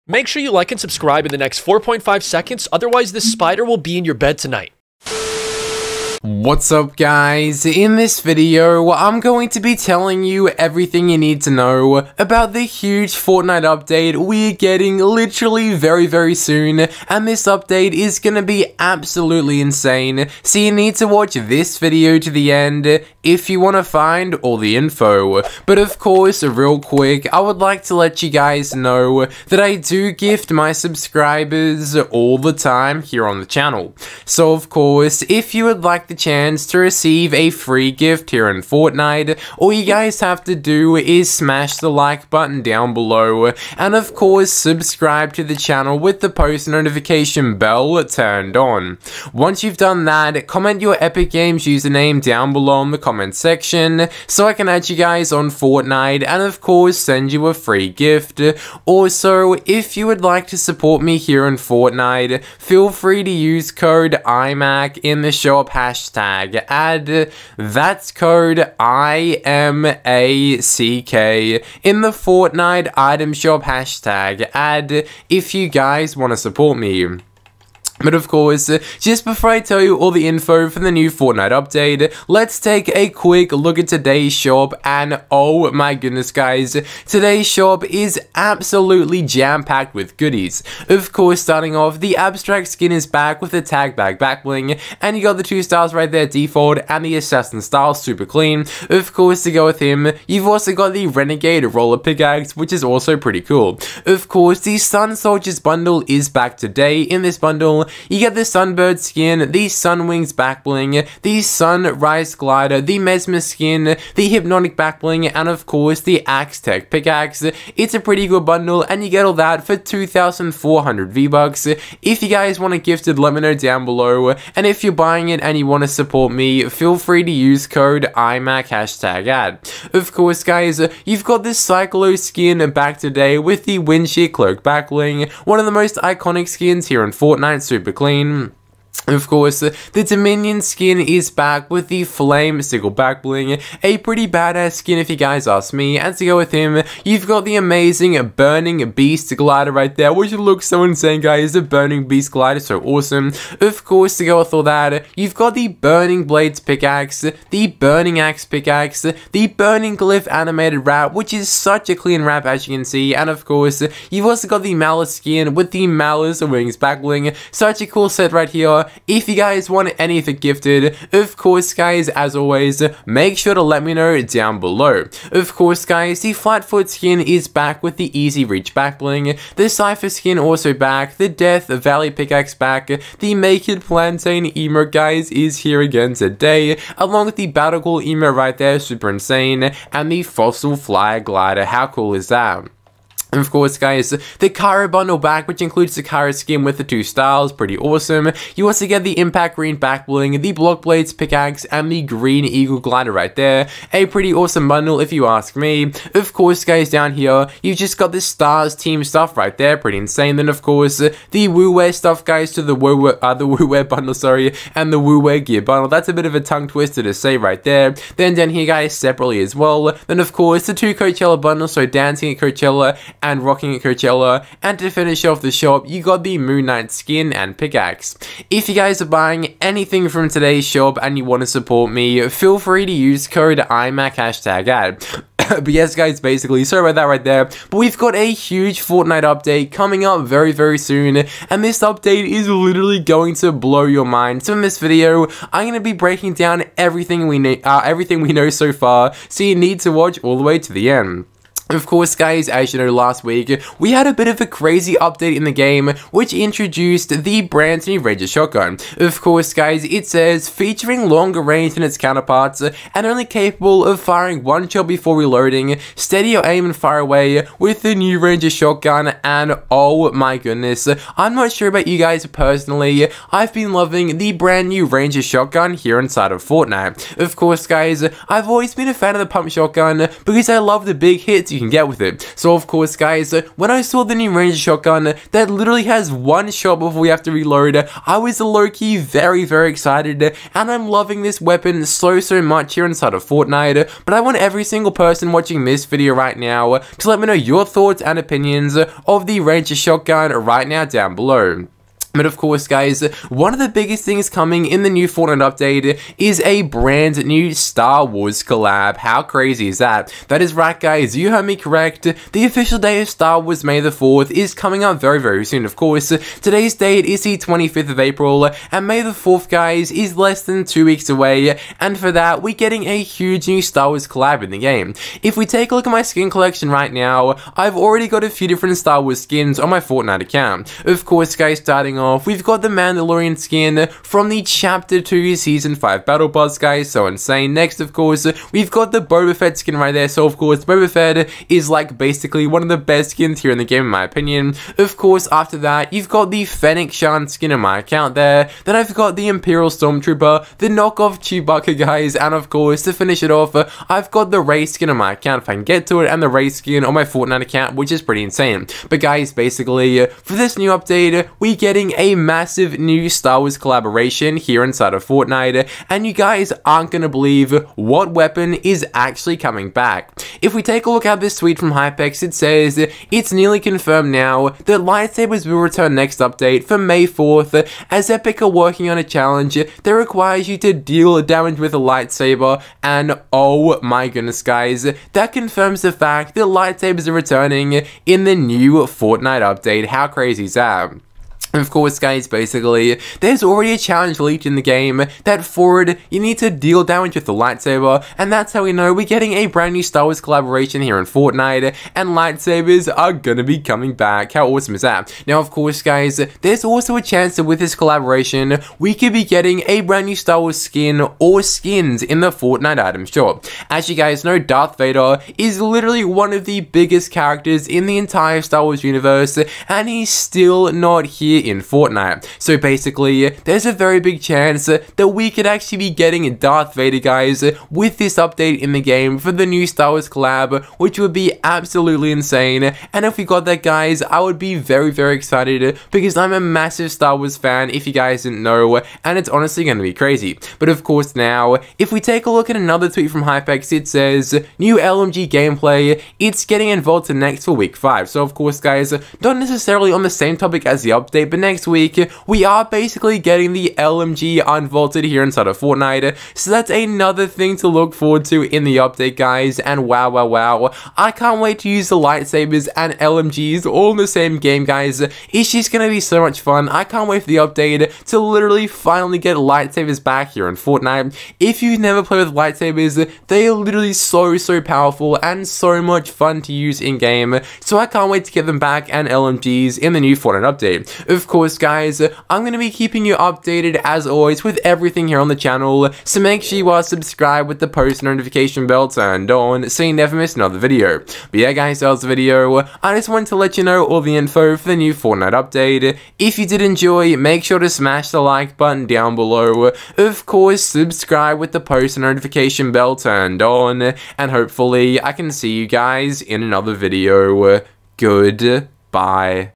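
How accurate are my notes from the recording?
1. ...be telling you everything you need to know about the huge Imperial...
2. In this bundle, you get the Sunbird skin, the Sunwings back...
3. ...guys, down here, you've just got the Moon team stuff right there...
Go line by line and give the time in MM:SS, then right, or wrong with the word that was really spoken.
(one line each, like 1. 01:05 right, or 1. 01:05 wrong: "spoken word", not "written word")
1. 00:09 wrong: "Fortnite", not "Imperial"
2. 01:47 right
3. 03:26 wrong: "Stars", not "Moon".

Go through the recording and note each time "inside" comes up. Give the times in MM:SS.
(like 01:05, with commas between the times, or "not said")
04:36, 04:52, 06:04, 07:35.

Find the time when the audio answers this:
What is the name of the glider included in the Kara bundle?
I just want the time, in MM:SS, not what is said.
03:22.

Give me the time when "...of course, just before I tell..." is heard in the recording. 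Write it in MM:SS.
01:18.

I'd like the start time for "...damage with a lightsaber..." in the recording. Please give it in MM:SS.
06:21.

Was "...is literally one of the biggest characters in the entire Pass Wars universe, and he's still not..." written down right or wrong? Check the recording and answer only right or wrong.
wrong.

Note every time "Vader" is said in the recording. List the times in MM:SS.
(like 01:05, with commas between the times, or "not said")
06:54, 07:06.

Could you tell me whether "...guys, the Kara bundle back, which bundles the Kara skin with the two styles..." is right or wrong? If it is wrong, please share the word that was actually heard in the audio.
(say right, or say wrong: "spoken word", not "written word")
wrong: "includes", not "bundles".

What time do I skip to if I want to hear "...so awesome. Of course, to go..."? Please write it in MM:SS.
02:32.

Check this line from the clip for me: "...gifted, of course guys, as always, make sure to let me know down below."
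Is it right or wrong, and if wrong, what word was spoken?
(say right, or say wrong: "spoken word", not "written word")
right.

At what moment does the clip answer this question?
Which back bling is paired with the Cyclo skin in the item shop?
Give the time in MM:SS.
02:13.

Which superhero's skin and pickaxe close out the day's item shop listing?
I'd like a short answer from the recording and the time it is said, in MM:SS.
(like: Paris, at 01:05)
Moon Knight, at 03:46.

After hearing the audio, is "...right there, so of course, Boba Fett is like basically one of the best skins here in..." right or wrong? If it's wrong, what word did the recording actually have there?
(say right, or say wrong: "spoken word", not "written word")
right.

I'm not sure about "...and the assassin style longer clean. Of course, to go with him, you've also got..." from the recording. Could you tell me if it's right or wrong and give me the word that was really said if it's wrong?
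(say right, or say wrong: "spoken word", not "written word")
wrong: "super", not "longer".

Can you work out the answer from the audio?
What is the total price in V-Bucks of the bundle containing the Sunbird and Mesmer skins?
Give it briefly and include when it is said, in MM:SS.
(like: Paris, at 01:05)
2,400, at 01:59.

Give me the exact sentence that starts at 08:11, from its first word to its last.
But yeah guys, that was the video.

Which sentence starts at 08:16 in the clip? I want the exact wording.
If you did enjoy, make sure to smash the like button down below.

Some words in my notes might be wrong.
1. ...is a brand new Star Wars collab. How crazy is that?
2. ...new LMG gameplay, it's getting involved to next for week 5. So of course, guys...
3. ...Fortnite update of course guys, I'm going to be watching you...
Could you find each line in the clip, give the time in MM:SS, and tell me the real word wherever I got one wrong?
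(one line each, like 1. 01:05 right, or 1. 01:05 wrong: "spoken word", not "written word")
1. 05:06 right
2. 07:24 right
3. 08:00 wrong: "keeping", not "watching".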